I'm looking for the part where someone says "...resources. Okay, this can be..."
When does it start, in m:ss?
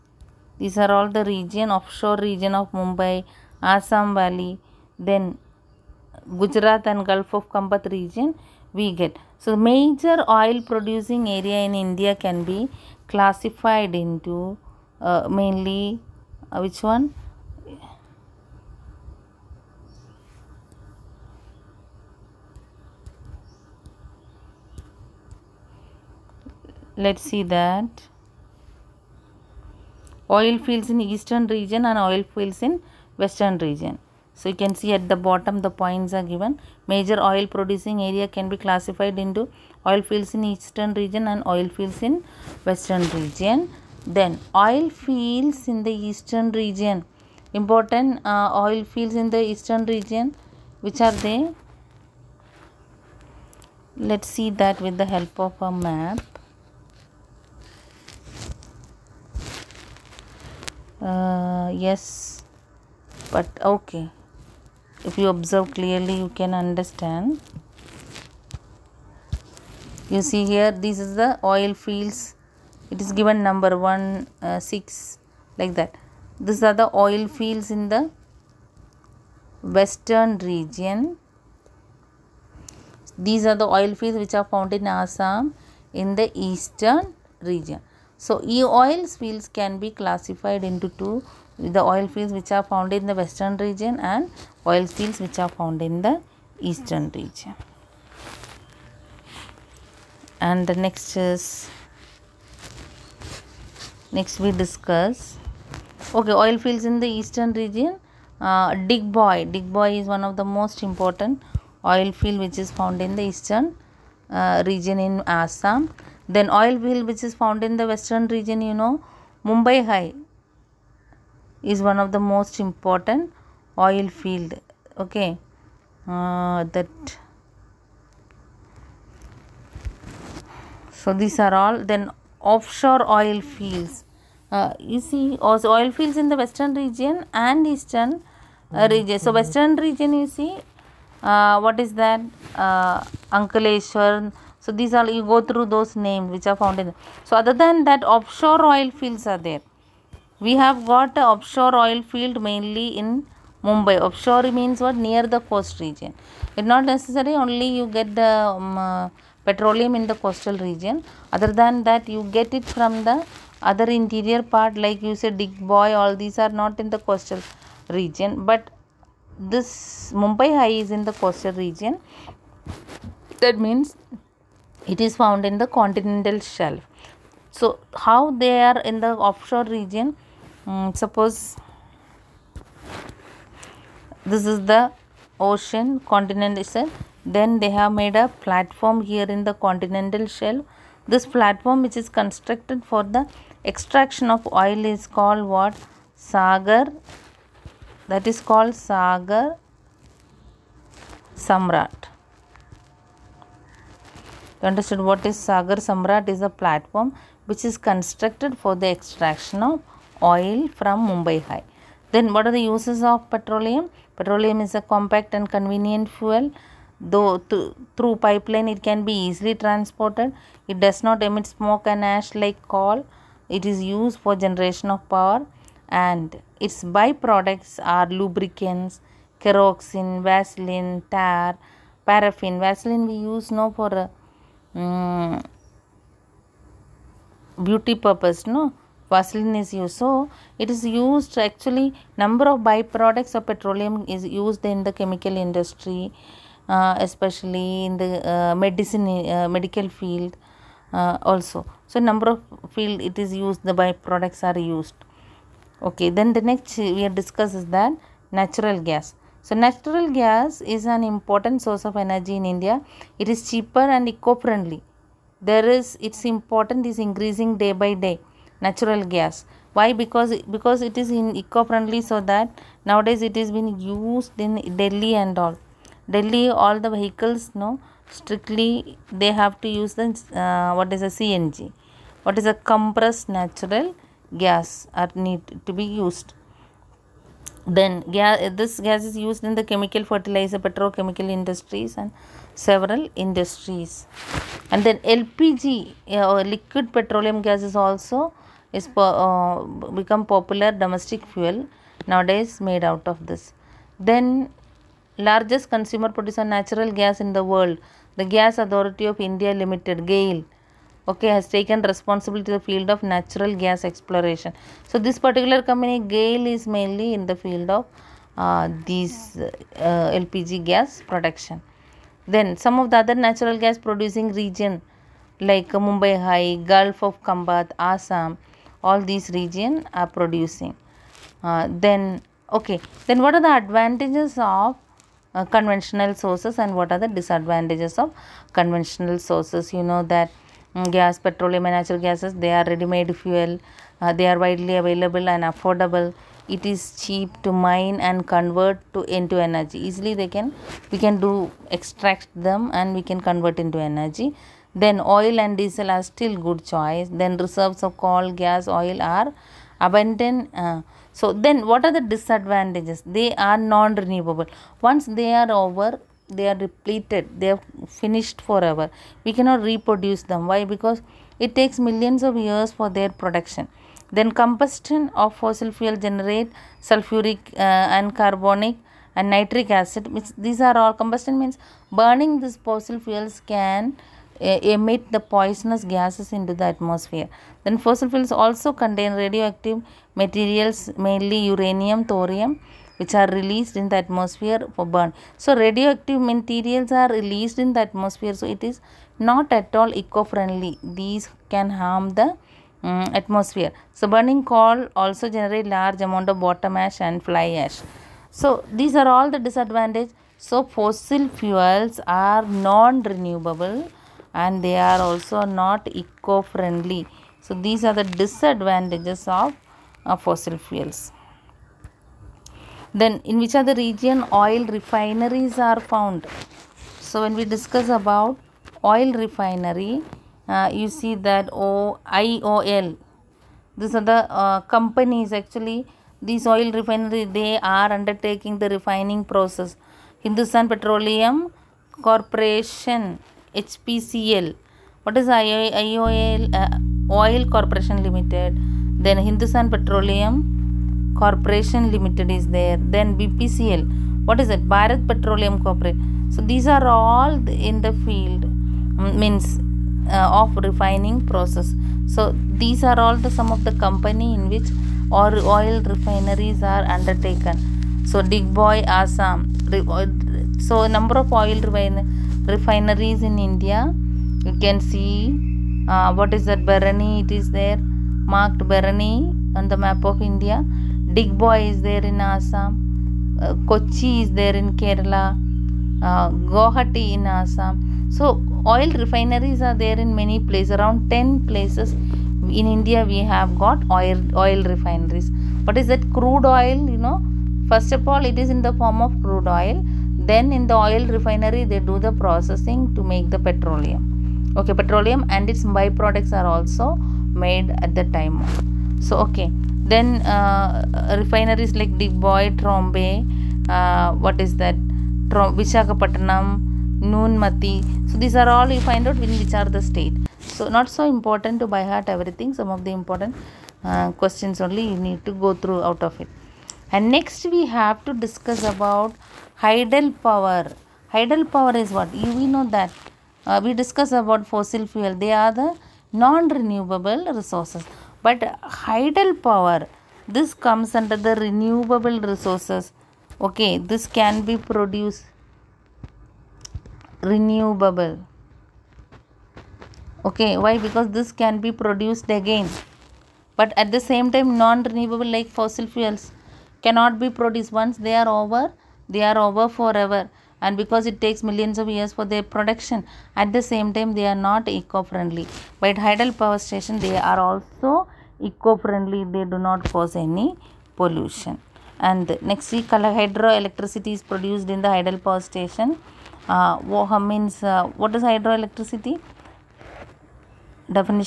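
9:02.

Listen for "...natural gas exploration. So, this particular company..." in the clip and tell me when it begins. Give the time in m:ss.
5:13.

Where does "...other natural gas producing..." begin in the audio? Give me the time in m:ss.
5:22.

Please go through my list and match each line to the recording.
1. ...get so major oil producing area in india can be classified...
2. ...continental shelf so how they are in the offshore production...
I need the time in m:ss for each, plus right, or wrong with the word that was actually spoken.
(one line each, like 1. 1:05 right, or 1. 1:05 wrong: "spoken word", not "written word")
1. 0:09 right
2. 2:55 wrong: "region", not "production".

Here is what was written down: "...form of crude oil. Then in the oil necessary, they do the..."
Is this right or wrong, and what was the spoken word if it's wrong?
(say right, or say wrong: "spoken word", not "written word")
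wrong: "refinery", not "necessary".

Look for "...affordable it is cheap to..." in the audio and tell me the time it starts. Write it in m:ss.
5:45.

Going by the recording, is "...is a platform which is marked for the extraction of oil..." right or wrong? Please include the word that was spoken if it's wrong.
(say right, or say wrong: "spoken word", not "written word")
wrong: "constructed", not "marked".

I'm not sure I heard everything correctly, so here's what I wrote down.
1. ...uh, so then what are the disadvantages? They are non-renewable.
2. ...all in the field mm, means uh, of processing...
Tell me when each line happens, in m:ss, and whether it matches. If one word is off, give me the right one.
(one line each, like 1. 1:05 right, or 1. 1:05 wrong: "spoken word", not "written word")
1. 6:00 right
2. 7:36 wrong: "refining", not "processing".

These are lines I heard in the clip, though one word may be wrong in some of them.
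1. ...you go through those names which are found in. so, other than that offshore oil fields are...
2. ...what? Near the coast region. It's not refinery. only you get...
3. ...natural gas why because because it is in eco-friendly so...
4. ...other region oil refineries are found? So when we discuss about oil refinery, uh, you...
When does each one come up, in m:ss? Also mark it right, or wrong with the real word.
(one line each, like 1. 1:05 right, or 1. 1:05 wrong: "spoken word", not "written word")
1. 2:25 right
2. 2:34 wrong: "necessary", not "refinery"
3. 4:28 right
4. 7:03 right.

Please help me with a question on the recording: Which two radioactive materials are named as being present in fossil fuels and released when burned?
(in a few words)
uranium, thorium.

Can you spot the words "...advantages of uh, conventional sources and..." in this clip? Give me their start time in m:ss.
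5:33.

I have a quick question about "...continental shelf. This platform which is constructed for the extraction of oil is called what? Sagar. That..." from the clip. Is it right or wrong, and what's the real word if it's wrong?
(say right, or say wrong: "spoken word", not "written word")
right.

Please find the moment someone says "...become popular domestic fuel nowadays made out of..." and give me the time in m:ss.
5:00.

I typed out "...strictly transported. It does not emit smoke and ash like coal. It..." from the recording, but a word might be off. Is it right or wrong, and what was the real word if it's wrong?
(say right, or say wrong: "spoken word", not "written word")
wrong: "easily", not "strictly".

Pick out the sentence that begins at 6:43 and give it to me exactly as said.
So burning coal also generate large amount of bottom ash and fly ash.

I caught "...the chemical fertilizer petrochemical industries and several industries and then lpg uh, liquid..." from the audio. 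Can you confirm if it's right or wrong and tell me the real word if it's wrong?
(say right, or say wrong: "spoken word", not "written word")
right.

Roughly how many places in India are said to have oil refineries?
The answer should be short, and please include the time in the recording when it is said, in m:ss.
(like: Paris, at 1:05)
10, at 8:10.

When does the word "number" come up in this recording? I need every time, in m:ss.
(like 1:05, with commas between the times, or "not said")
1:13, 4:02, 4:11, 7:50.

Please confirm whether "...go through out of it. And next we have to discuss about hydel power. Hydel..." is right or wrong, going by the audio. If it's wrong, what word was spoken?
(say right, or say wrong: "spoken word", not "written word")
right.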